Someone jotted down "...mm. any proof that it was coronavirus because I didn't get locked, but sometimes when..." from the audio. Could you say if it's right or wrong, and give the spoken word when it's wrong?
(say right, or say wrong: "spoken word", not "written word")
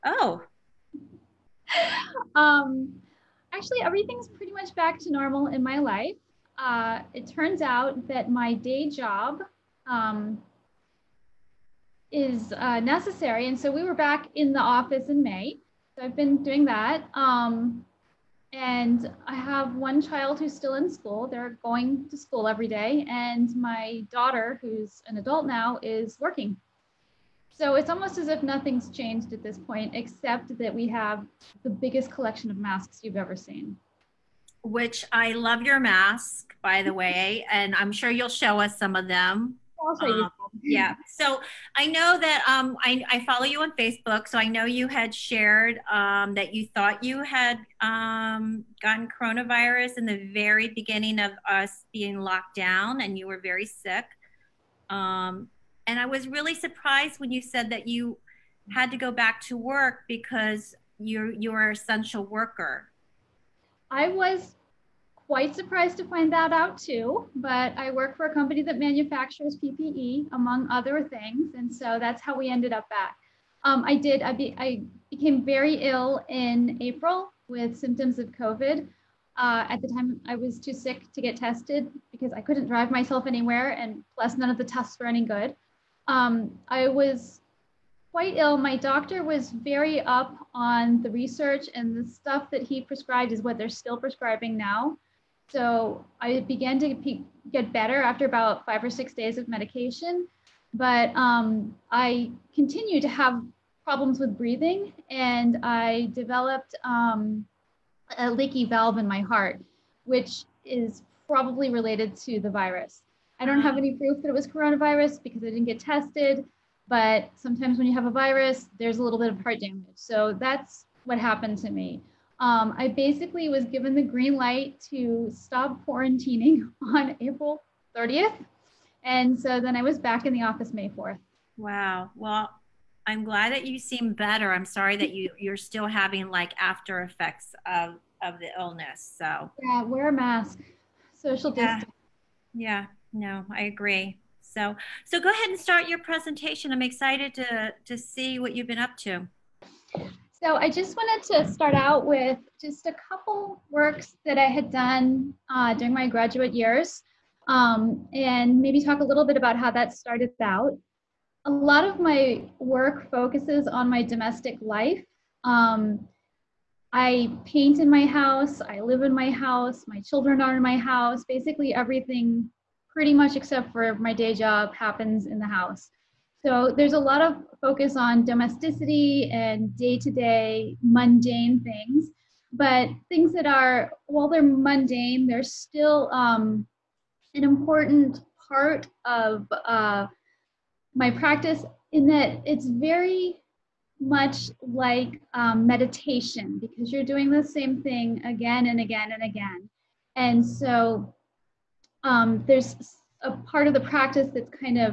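wrong: "tested", not "locked".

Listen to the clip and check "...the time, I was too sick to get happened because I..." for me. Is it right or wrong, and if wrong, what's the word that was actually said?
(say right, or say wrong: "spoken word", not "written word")
wrong: "tested", not "happened".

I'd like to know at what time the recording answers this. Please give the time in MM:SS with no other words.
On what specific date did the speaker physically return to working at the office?
02:10.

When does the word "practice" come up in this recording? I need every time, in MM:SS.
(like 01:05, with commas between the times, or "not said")
03:11, 03:23.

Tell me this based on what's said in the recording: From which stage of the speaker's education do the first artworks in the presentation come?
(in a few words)
graduate years.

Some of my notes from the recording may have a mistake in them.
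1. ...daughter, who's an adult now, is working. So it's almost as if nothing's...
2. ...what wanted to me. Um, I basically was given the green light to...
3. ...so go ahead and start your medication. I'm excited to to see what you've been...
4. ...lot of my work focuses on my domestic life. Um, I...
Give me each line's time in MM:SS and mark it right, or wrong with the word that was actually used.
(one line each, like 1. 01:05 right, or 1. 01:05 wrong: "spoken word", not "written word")
1. 00:24 right
2. 02:01 wrong: "happened", not "wanted"
3. 02:25 wrong: "presentation", not "medication"
4. 02:41 right.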